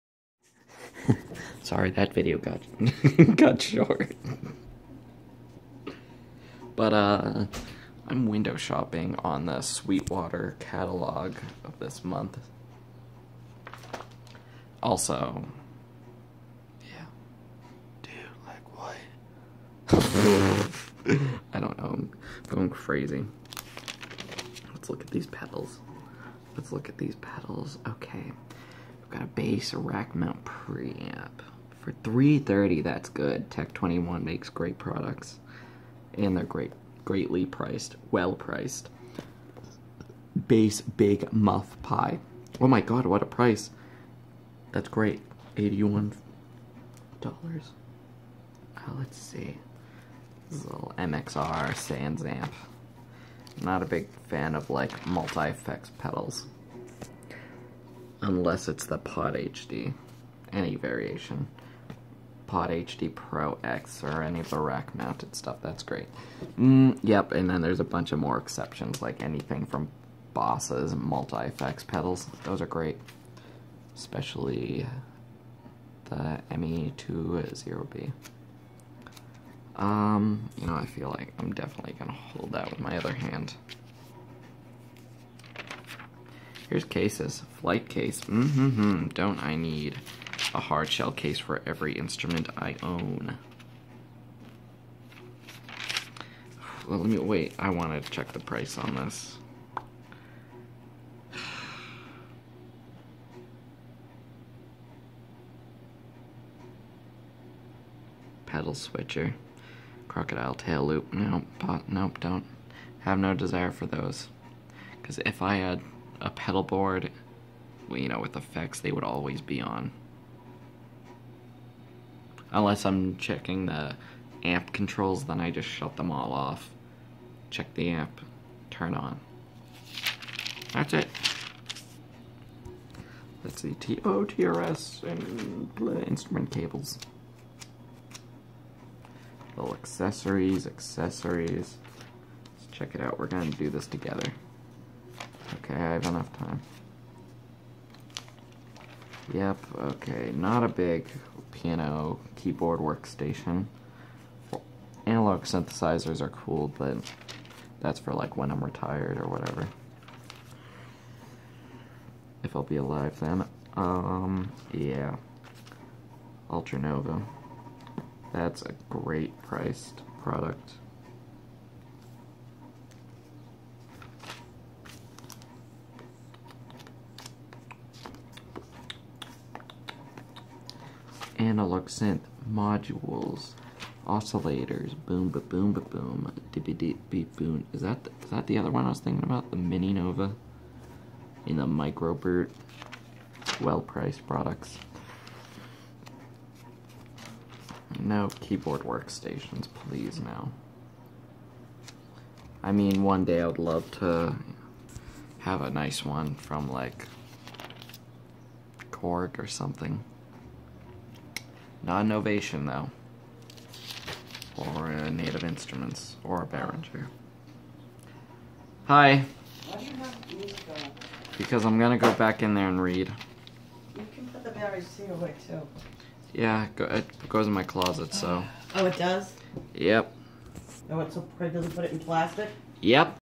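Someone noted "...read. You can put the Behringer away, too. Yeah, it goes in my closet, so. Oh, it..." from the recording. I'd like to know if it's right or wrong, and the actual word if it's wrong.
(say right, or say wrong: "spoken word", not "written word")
right.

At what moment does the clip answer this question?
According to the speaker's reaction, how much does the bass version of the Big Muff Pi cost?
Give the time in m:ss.
0:45.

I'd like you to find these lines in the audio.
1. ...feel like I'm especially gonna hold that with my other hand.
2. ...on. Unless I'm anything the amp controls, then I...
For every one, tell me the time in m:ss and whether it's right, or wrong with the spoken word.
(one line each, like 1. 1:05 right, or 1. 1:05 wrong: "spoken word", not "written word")
1. 1:20 wrong: "definitely", not "especially"
2. 1:59 wrong: "checking", not "anything".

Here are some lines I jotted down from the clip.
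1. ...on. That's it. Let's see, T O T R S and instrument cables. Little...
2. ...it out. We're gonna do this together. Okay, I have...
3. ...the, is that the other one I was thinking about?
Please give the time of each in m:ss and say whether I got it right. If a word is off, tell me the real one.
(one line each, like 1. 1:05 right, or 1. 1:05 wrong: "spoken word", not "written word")
1. 2:08 right
2. 2:22 right
3. 3:08 right.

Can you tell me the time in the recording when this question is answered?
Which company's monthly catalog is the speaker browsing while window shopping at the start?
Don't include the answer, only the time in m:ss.
0:09.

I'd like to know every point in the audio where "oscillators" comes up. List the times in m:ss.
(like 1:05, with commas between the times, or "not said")
3:04.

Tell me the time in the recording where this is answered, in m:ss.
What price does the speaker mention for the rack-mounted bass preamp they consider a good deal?
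0:32.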